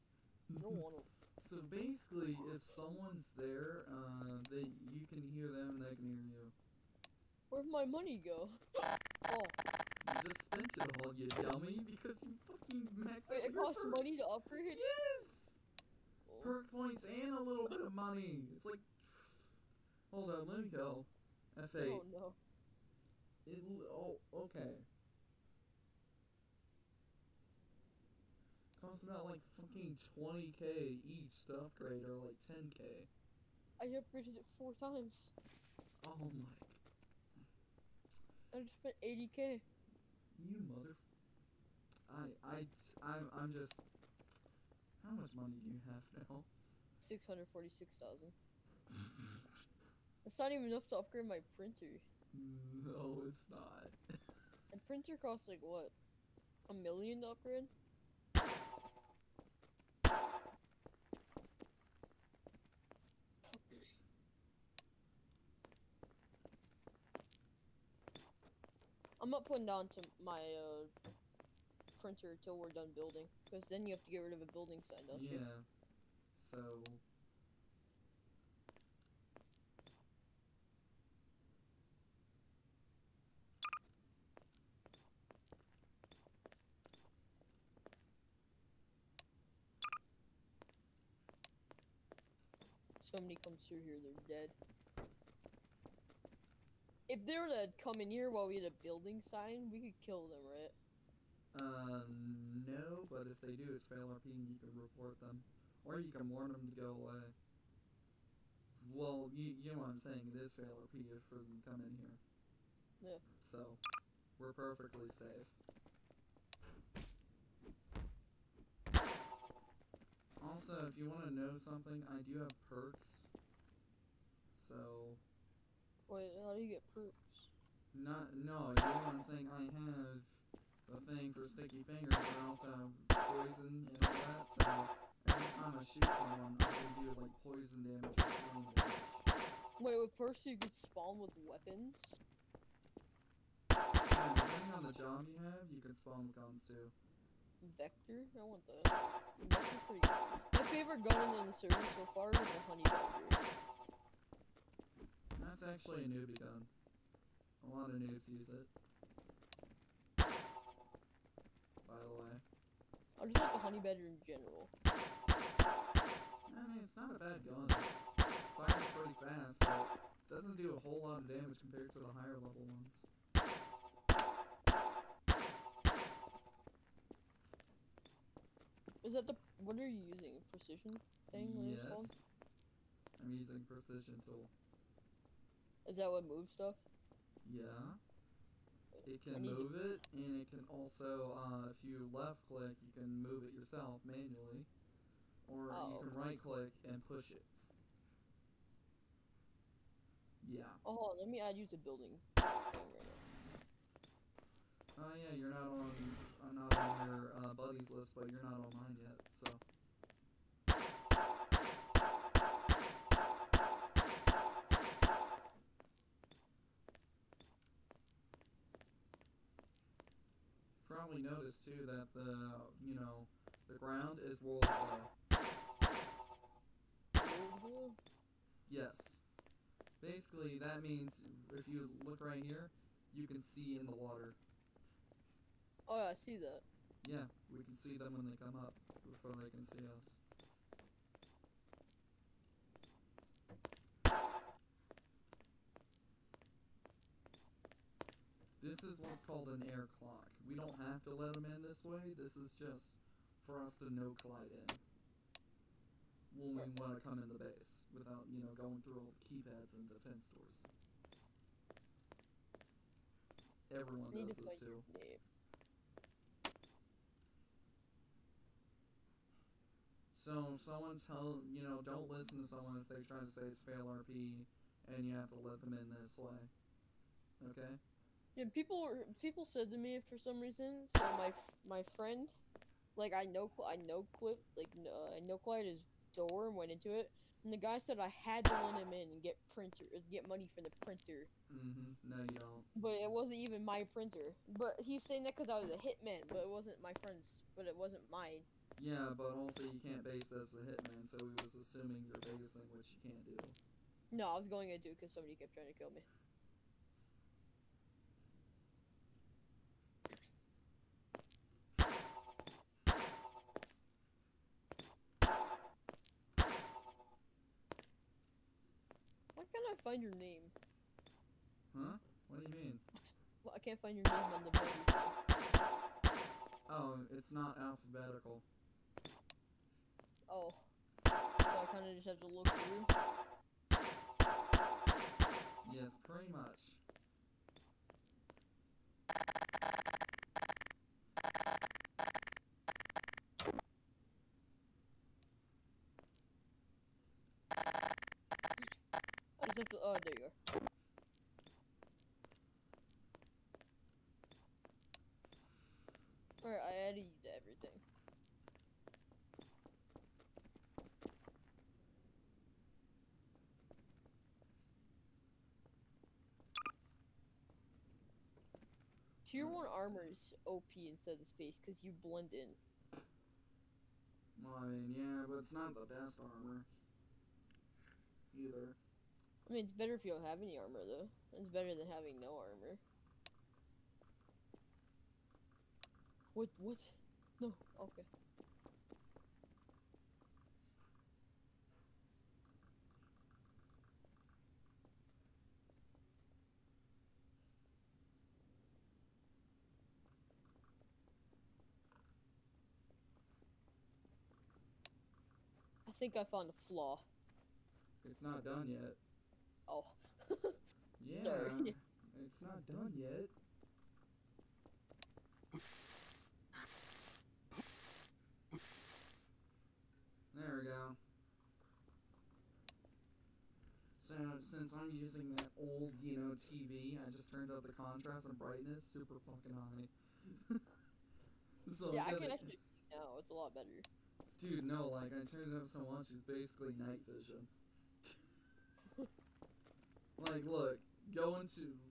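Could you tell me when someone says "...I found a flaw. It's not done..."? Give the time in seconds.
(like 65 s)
406 s.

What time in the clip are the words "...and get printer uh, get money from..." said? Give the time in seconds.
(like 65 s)
289 s.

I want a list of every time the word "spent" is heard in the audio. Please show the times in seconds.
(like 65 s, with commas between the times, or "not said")
10 s, 38 s.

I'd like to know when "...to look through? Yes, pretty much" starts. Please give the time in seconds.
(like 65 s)
332 s.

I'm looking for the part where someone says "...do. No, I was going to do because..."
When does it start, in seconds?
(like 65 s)
303 s.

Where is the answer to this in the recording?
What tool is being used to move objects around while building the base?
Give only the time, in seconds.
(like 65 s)
183 s.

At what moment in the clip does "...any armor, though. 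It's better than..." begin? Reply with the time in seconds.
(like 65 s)
380 s.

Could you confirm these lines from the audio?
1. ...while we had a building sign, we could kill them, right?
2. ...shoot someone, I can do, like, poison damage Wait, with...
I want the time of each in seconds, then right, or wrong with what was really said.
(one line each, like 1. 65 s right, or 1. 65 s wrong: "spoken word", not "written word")
1. 98 s right
2. 135 s right.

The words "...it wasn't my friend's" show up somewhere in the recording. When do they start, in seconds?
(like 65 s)
296 s.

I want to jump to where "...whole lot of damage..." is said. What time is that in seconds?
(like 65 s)
170 s.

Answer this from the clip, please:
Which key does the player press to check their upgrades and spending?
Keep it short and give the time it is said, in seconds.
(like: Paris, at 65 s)
F8, at 21 s.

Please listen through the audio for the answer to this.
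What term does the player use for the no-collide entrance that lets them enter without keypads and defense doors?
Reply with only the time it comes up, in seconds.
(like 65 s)
249 s.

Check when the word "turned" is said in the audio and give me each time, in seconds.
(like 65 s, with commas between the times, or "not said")
427 s, 435 s.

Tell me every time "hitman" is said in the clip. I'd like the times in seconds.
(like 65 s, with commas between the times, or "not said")
295 s, 300 s.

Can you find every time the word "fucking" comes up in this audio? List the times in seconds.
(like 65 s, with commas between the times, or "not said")
12 s, 29 s, 429 s.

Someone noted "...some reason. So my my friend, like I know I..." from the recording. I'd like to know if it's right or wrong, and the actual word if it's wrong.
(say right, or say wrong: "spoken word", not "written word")
right.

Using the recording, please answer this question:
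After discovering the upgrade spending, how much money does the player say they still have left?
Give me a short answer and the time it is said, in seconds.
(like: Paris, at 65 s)
646,000, at 46 s.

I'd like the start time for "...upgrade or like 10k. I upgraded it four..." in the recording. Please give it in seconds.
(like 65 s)
31 s.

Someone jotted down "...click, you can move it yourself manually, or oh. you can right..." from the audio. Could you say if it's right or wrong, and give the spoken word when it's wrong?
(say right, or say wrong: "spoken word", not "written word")
right.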